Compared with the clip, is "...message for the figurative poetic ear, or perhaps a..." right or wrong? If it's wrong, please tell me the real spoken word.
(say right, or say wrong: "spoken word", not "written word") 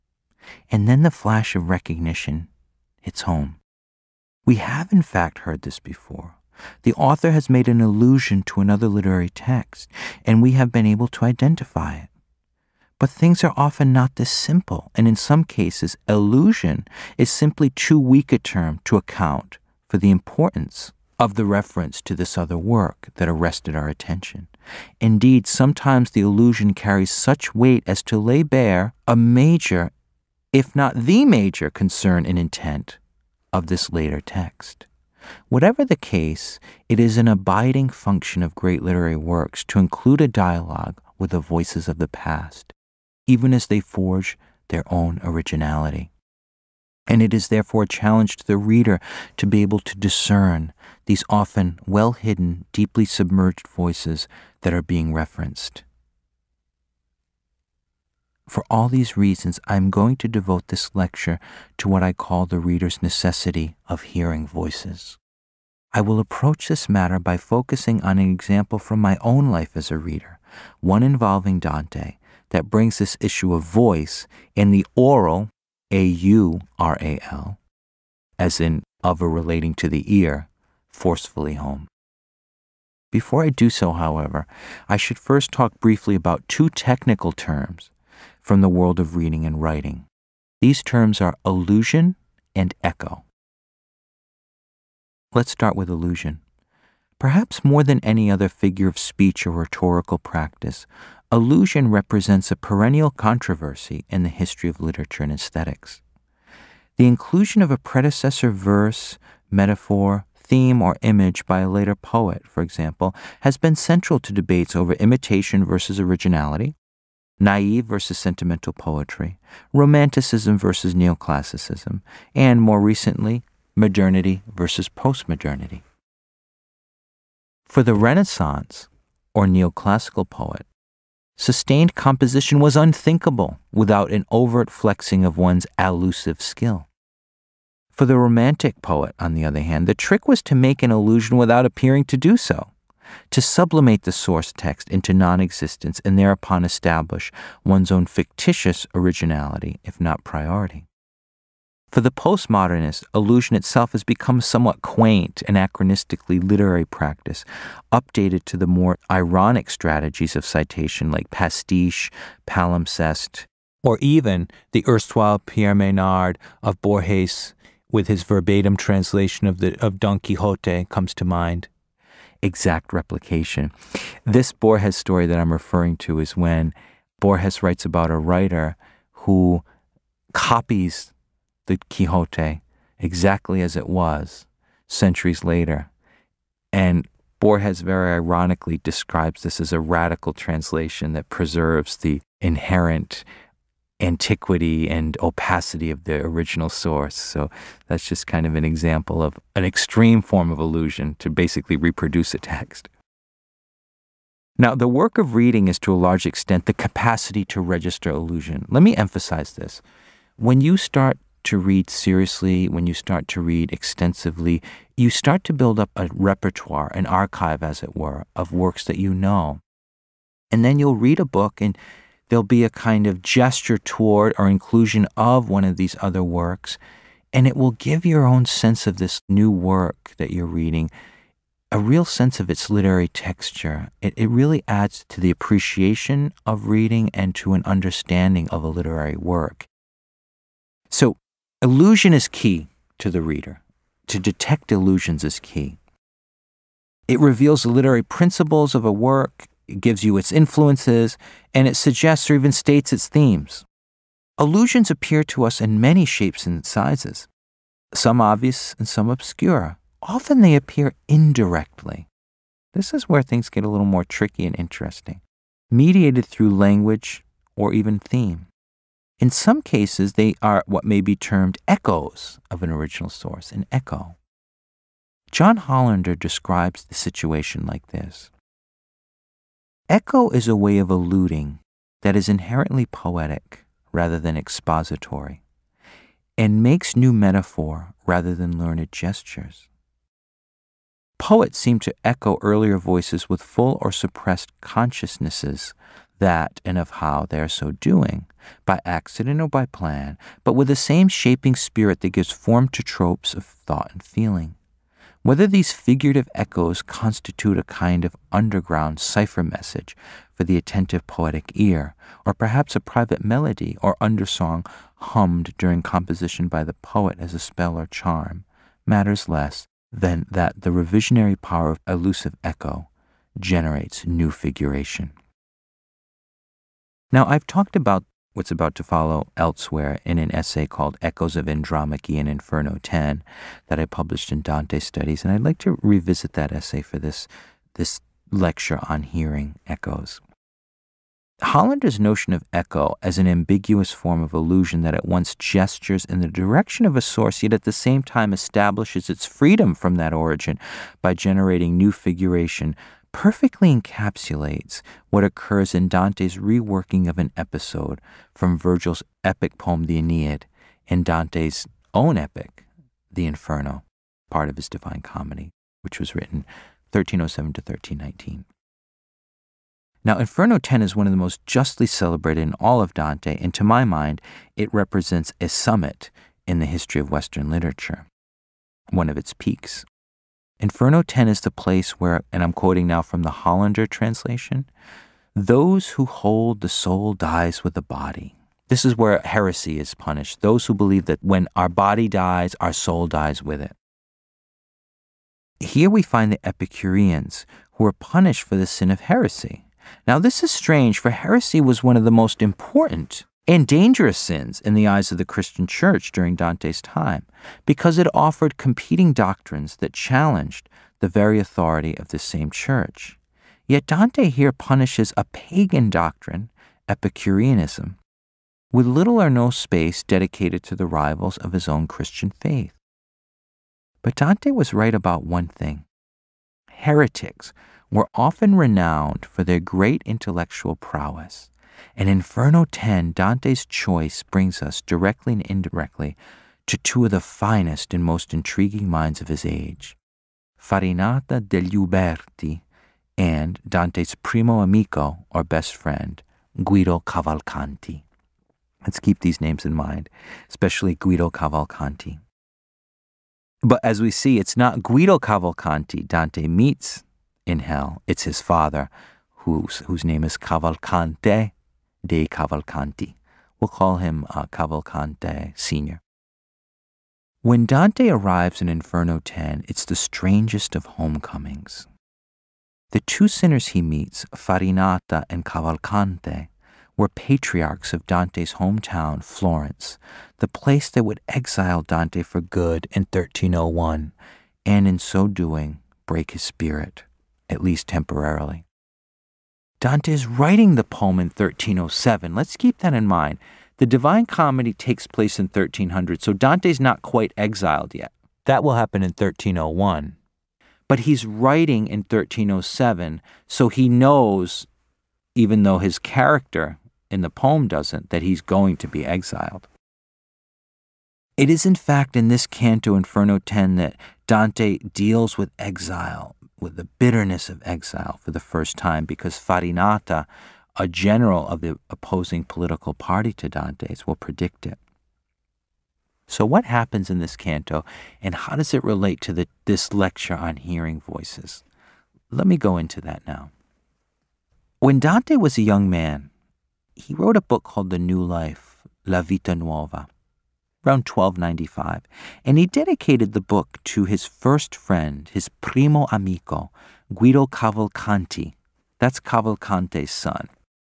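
wrong: "attentive", not "figurative".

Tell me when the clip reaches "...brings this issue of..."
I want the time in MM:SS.
01:12.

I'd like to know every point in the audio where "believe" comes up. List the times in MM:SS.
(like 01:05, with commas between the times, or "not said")
06:30.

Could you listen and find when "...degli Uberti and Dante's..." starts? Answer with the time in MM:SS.
07:21.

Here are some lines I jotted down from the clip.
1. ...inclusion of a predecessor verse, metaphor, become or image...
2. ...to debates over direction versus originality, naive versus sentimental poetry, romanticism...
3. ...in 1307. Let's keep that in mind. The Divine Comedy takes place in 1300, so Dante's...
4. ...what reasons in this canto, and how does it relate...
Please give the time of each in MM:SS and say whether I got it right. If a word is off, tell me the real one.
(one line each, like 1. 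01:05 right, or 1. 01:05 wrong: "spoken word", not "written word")
1. 01:47 wrong: "theme", not "become"
2. 01:54 wrong: "imitation", not "direction"
3. 08:11 right
4. 08:46 wrong: "happens", not "reasons".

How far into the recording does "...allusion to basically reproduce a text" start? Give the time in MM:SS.
03:20.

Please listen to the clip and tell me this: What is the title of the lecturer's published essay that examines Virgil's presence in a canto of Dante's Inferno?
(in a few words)
Echoes of Andromache in Inferno 10.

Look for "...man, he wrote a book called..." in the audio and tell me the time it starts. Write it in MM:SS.
08:55.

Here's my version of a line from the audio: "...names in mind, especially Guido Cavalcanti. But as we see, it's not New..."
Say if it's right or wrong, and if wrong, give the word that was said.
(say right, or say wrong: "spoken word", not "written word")
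wrong: "Guido", not "New".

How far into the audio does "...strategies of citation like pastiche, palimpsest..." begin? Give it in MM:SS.
02:39.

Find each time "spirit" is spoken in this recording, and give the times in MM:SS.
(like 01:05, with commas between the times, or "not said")
05:01, 08:06.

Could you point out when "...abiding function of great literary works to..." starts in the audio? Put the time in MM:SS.
00:37.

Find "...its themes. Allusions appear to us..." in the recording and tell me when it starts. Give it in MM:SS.
04:12.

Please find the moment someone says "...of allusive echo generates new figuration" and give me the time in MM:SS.
05:21.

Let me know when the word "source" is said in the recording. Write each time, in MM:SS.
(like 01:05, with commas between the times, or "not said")
02:24, 03:16, 04:33, 05:47.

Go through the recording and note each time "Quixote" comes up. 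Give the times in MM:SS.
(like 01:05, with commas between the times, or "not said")
02:50, 03:01.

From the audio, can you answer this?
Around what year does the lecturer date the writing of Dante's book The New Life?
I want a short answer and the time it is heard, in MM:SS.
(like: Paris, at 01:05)
1295, at 09:01.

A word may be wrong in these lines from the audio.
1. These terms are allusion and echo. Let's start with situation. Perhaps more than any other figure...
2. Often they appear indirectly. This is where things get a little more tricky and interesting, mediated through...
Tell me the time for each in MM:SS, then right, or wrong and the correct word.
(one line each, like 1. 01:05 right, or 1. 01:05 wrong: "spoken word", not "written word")
1. 01:30 wrong: "allusion", not "situation"
2. 04:20 right.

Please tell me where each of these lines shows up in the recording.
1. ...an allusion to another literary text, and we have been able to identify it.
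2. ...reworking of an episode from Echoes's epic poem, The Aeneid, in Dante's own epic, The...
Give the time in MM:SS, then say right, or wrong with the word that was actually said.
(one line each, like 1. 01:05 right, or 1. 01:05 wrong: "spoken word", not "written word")
1. 00:07 right
2. 05:56 wrong: "Virgil", not "Echoes".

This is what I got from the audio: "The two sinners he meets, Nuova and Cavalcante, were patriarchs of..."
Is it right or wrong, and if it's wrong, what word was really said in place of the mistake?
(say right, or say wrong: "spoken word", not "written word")
wrong: "Farinata", not "Nuova".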